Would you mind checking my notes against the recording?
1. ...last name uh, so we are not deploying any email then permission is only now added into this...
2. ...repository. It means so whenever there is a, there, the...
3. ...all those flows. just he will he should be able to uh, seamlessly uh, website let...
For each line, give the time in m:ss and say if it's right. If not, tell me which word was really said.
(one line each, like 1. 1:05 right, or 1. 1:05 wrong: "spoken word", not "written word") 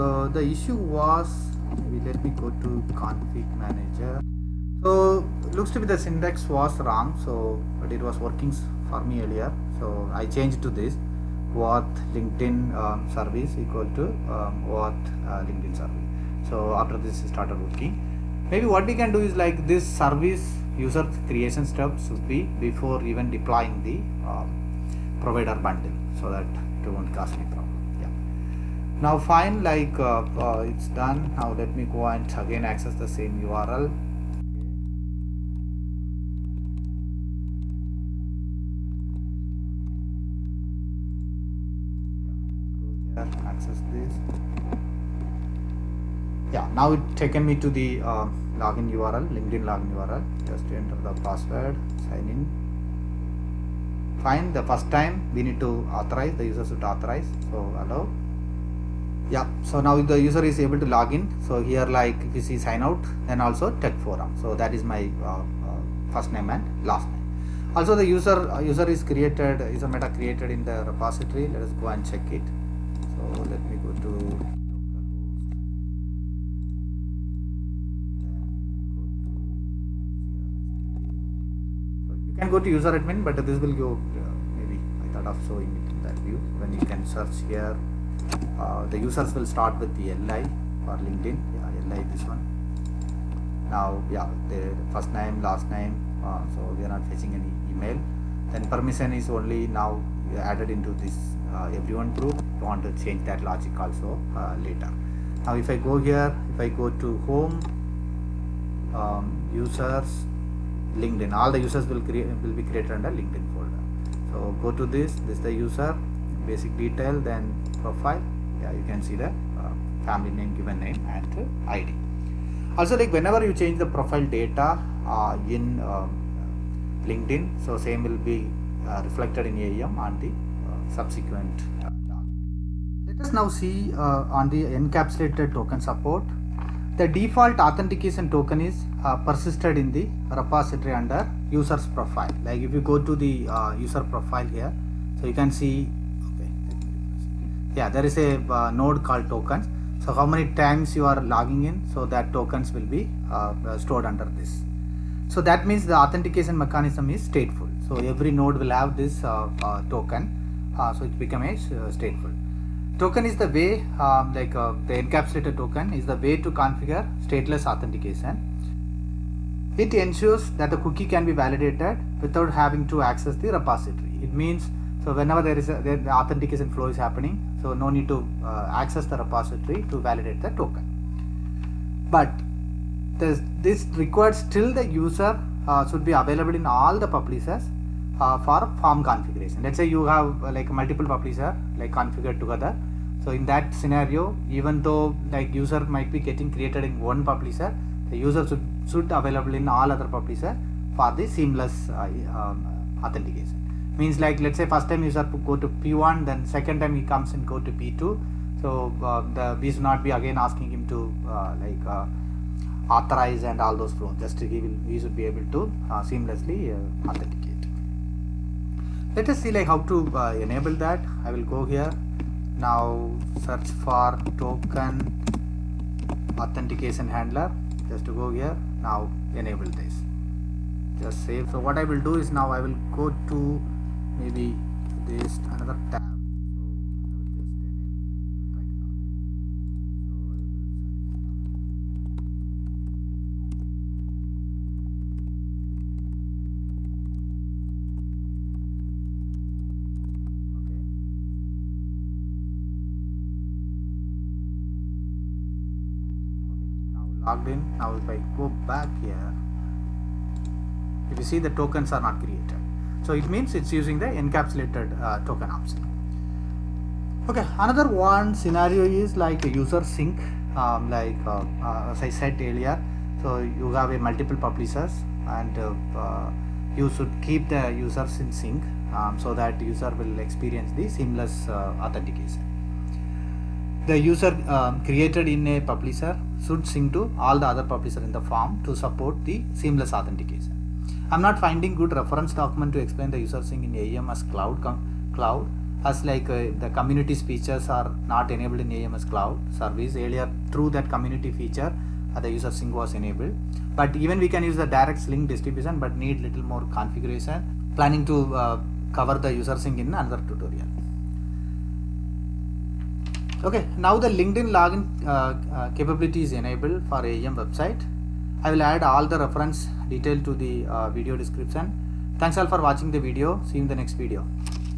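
1. 1:35 wrong: "fetching", not "deploying"
2. 2:53 right
3. 3:33 wrong: "authenticate", not "website".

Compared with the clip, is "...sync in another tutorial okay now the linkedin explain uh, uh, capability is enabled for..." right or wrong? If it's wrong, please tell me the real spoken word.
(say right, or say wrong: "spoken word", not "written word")
wrong: "login", not "explain".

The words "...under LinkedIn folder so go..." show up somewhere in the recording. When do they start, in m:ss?
1:52.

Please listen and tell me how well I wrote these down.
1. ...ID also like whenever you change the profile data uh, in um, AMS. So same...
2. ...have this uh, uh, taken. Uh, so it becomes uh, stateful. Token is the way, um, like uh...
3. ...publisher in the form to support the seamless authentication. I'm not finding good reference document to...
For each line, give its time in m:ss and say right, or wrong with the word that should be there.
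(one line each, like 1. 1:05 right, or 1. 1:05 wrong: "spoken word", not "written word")
1. 2:01 wrong: "LinkedIn", not "AMS"
2. 2:38 wrong: "token", not "taken"
3. 4:47 right.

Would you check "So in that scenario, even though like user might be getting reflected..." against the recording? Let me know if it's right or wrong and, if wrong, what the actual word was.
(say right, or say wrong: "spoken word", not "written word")
wrong: "created", not "reflected".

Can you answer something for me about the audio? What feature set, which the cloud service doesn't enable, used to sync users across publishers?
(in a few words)
community features.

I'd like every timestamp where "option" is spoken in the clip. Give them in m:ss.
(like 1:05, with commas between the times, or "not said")
4:25.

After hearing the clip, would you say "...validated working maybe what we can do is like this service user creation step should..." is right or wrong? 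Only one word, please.
wrong.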